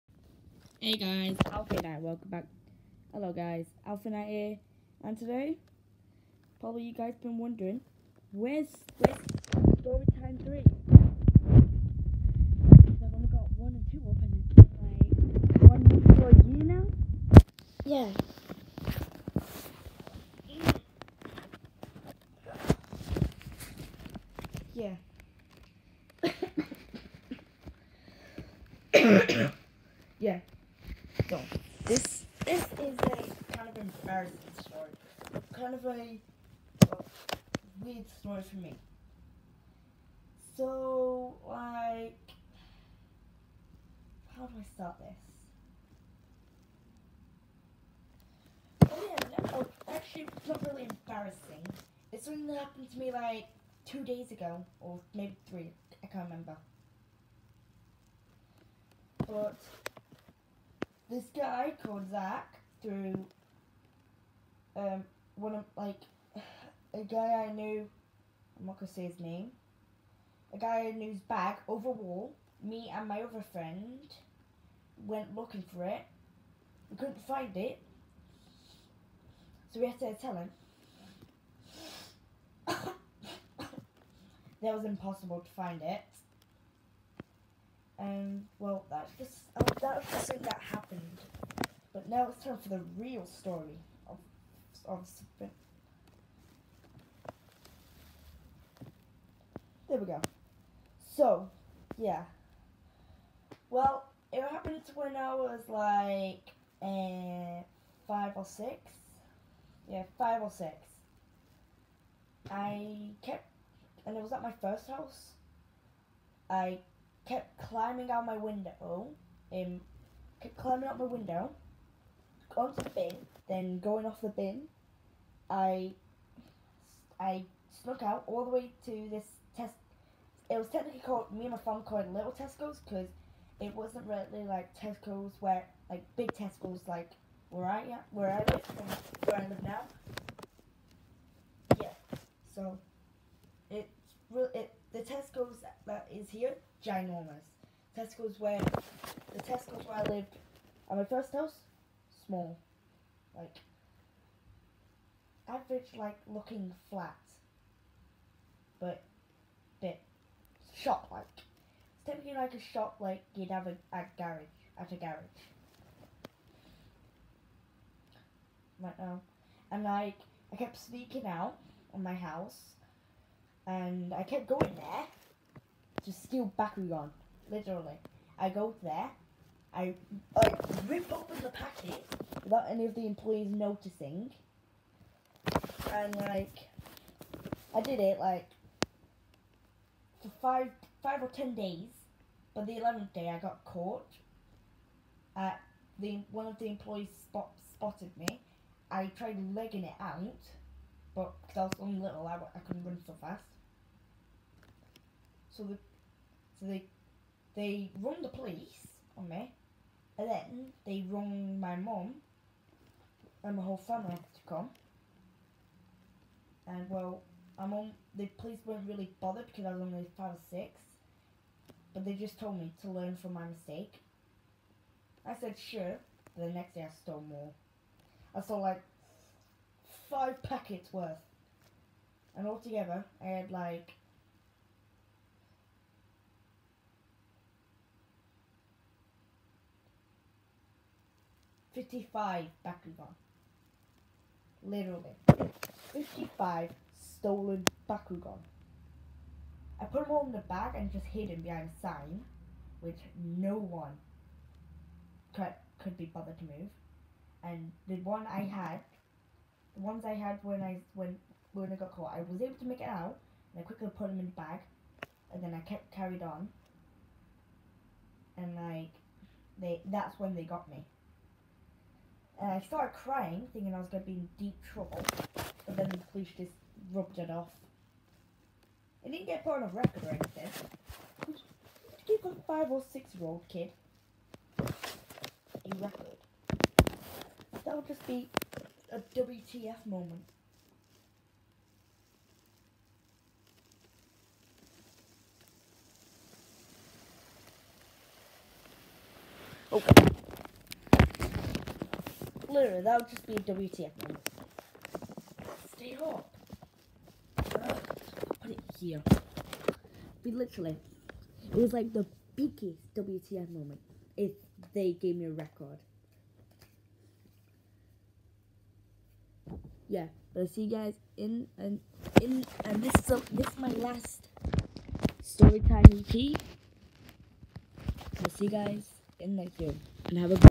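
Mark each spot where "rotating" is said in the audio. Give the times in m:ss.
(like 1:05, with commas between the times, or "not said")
not said.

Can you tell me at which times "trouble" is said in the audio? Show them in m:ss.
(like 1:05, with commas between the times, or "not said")
4:34.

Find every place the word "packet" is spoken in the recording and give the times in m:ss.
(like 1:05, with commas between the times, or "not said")
3:01, 3:50.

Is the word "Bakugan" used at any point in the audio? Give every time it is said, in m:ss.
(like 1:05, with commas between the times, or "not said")
2:56, 4:02, 4:07.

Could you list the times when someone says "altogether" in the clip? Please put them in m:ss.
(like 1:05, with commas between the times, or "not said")
3:52.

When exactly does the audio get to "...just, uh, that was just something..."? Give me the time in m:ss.
1:29.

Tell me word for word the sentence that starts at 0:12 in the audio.
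Because I've only got 1 and 2 up and like, 1 week for a year now?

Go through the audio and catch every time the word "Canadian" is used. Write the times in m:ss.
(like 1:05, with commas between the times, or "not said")
not said.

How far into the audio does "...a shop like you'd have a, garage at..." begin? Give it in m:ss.
2:42.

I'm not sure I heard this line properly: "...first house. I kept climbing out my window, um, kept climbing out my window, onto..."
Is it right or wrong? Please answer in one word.
right.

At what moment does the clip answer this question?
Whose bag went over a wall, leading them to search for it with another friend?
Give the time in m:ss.
1:02.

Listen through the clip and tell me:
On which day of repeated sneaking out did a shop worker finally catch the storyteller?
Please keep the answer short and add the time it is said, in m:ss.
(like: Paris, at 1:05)
The eleventh day, at 3:12.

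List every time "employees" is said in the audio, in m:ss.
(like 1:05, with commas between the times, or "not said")
3:03, 3:16.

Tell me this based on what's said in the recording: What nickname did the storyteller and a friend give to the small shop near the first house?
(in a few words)
Little Tesco's.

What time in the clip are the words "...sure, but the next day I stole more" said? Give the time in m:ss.
3:45.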